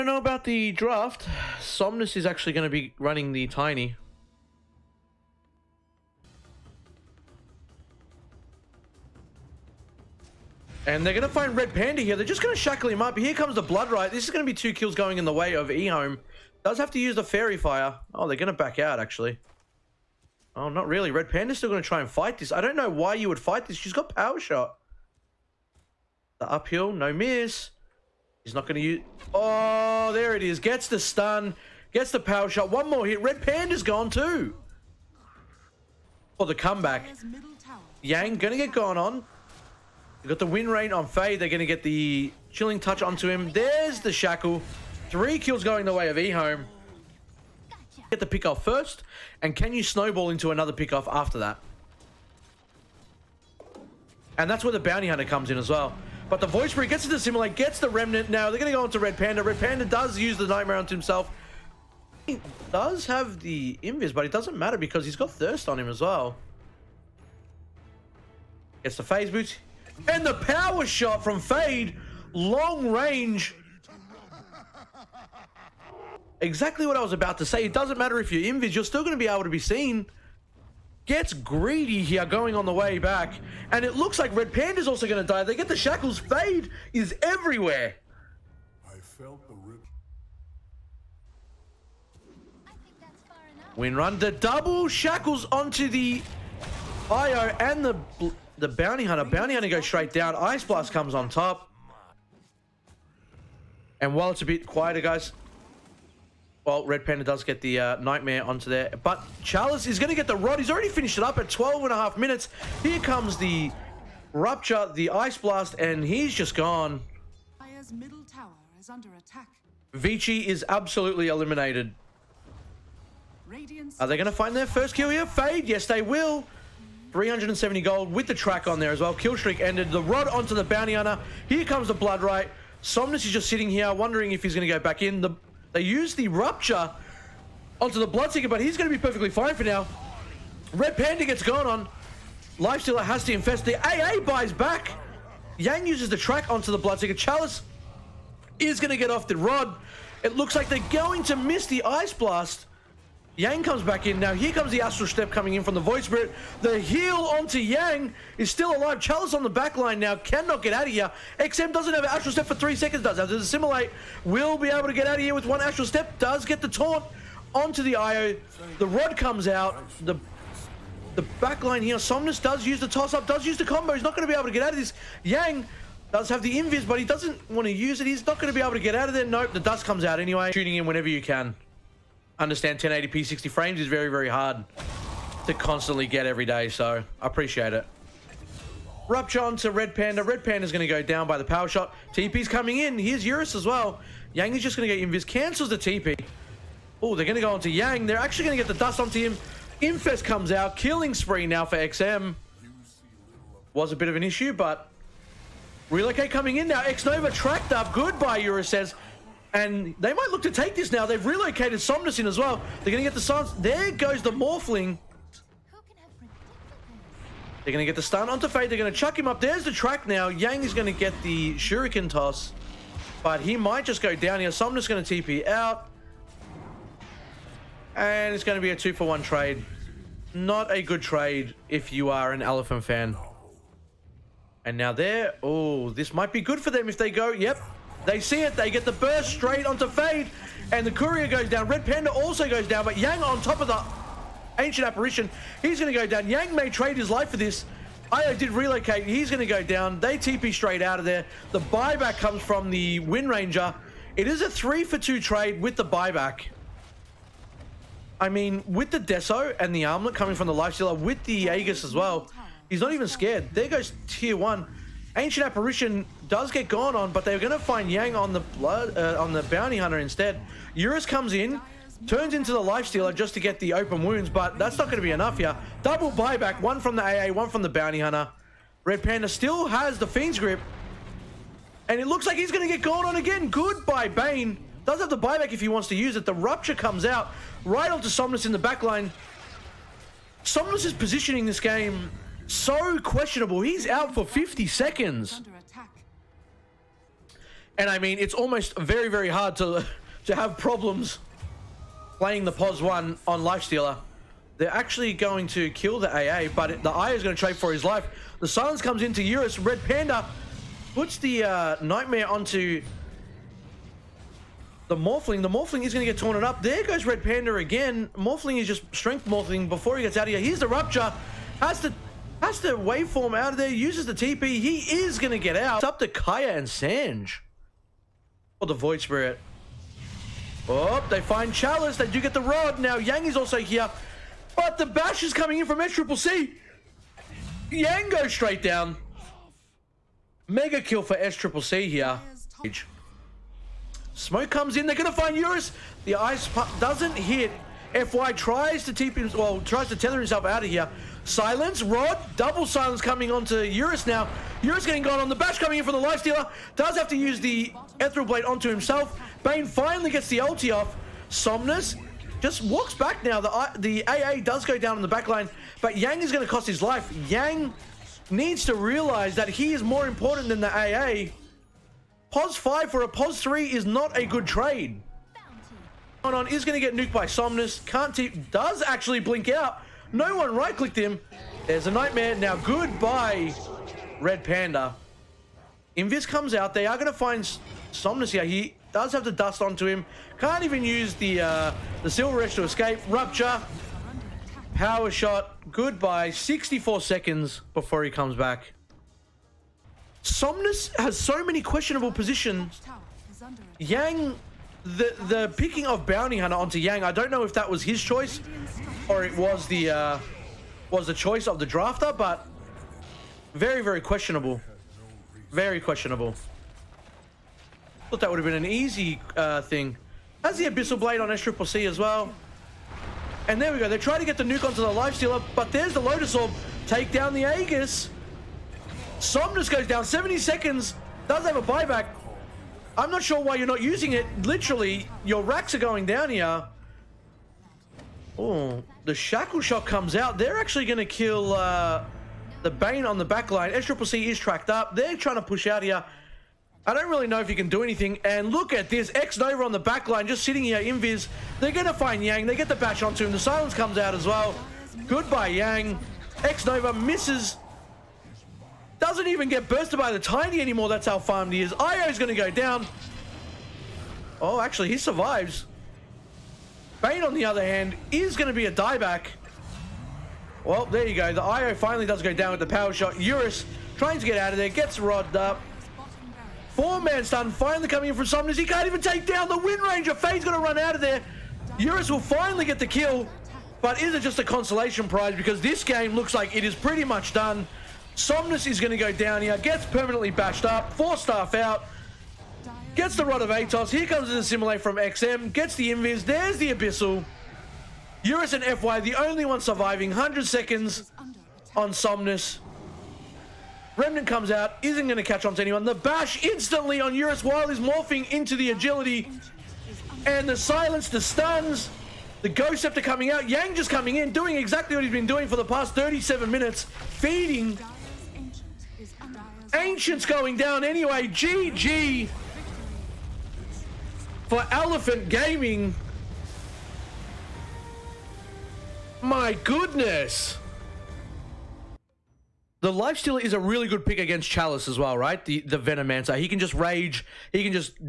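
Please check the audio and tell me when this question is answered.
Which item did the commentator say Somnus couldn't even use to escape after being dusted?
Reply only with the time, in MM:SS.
06:32.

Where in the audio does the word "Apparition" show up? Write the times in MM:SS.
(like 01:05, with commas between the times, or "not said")
04:04, 04:25.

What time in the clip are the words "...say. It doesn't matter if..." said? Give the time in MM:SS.
01:17.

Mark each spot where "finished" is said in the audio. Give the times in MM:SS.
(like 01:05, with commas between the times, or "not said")
01:50.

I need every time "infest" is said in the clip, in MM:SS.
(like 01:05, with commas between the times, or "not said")
02:23, 03:19.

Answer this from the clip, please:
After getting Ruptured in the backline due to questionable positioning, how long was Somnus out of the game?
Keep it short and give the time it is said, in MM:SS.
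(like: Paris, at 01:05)
50 seconds, at 04:54.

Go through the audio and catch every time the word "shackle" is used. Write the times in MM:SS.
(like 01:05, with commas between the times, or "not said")
00:12, 00:44, 01:25, 01:34, 07:19.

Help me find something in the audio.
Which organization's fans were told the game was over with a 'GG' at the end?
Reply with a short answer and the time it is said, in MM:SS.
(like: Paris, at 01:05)
Elephant Gaming, at 08:44.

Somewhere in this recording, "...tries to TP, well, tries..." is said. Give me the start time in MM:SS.
05:48.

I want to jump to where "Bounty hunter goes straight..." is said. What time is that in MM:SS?
01:39.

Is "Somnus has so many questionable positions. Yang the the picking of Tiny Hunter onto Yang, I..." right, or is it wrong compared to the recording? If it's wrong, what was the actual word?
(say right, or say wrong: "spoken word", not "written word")
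wrong: "Bounty", not "Tiny".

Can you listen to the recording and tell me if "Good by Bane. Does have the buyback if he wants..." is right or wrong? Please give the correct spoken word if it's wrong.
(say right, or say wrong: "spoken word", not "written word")
right.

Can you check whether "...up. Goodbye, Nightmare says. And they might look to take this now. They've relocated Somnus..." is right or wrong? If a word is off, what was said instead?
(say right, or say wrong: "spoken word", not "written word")
wrong: "Eurus", not "Nightmare".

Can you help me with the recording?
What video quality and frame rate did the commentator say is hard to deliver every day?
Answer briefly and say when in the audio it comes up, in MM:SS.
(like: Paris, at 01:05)
1080p 60 frames, at 03:02.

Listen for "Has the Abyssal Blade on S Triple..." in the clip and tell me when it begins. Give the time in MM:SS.
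07:00.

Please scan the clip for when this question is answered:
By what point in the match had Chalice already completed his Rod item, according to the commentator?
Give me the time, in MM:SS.
01:51.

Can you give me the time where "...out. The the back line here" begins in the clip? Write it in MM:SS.
02:49.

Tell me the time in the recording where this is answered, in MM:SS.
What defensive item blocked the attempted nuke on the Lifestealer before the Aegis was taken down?
07:05.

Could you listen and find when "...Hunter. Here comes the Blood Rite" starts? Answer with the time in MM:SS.
02:10.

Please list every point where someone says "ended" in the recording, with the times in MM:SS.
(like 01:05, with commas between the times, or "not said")
02:09.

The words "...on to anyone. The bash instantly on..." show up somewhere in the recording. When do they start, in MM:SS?
08:25.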